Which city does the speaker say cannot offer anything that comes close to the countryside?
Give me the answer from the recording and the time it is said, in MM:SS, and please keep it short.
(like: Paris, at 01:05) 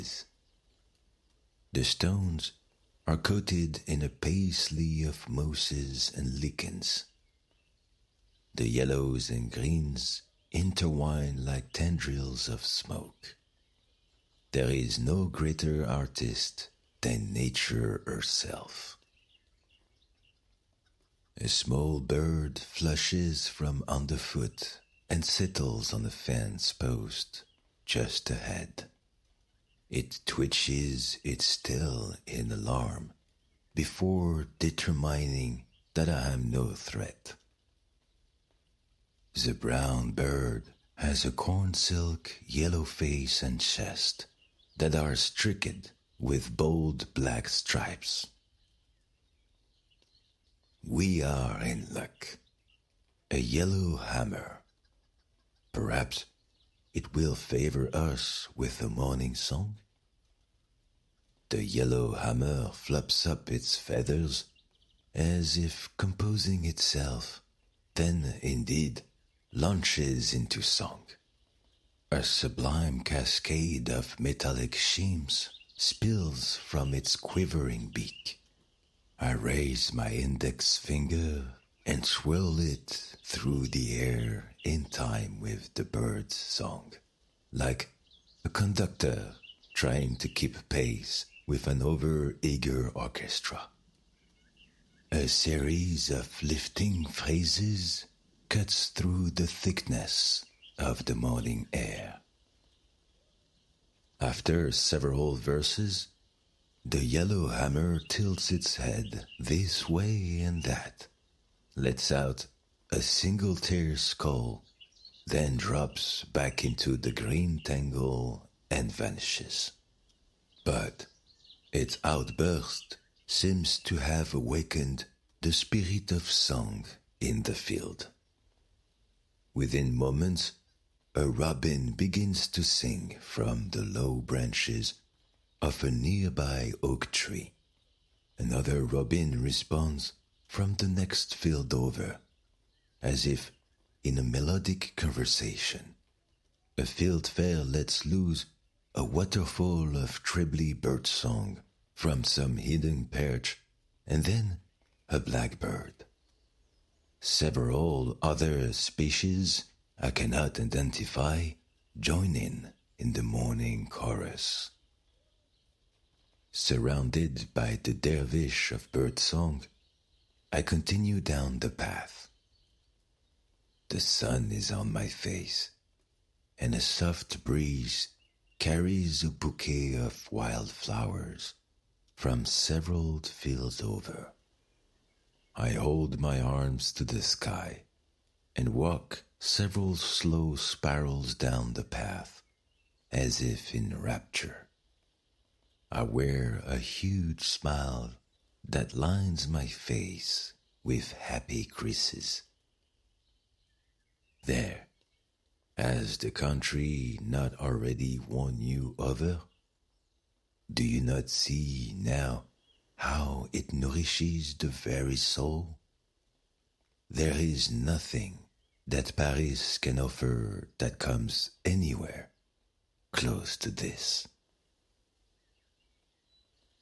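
Paris, at 03:39.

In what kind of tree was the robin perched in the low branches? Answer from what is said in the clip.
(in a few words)
Oak.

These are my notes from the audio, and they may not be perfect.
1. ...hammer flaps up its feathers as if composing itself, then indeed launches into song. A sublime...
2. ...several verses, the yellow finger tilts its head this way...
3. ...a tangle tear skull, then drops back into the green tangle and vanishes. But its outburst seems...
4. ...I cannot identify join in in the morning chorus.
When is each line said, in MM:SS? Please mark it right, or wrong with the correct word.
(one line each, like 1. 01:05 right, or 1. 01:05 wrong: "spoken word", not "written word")
1. 01:02 right
2. 01:44 wrong: "hammer", not "finger"
3. 01:52 wrong: "single", not "tangle"
4. 02:39 right.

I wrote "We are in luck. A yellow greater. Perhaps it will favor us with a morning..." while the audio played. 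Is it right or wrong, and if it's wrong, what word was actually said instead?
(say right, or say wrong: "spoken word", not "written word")
wrong: "hammer", not "greater".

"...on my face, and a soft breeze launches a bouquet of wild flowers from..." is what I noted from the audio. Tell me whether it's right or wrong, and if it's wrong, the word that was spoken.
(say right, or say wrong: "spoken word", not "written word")
wrong: "carries", not "launches".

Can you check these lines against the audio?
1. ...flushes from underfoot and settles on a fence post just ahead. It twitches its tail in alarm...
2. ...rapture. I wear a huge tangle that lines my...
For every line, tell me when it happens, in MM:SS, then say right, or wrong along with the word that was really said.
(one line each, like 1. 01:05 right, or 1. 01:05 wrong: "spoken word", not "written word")
1. 00:22 right
2. 03:13 wrong: "smile", not "tangle".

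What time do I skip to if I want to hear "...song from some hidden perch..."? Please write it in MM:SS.
02:31.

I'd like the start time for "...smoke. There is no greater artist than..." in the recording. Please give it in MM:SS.
00:12.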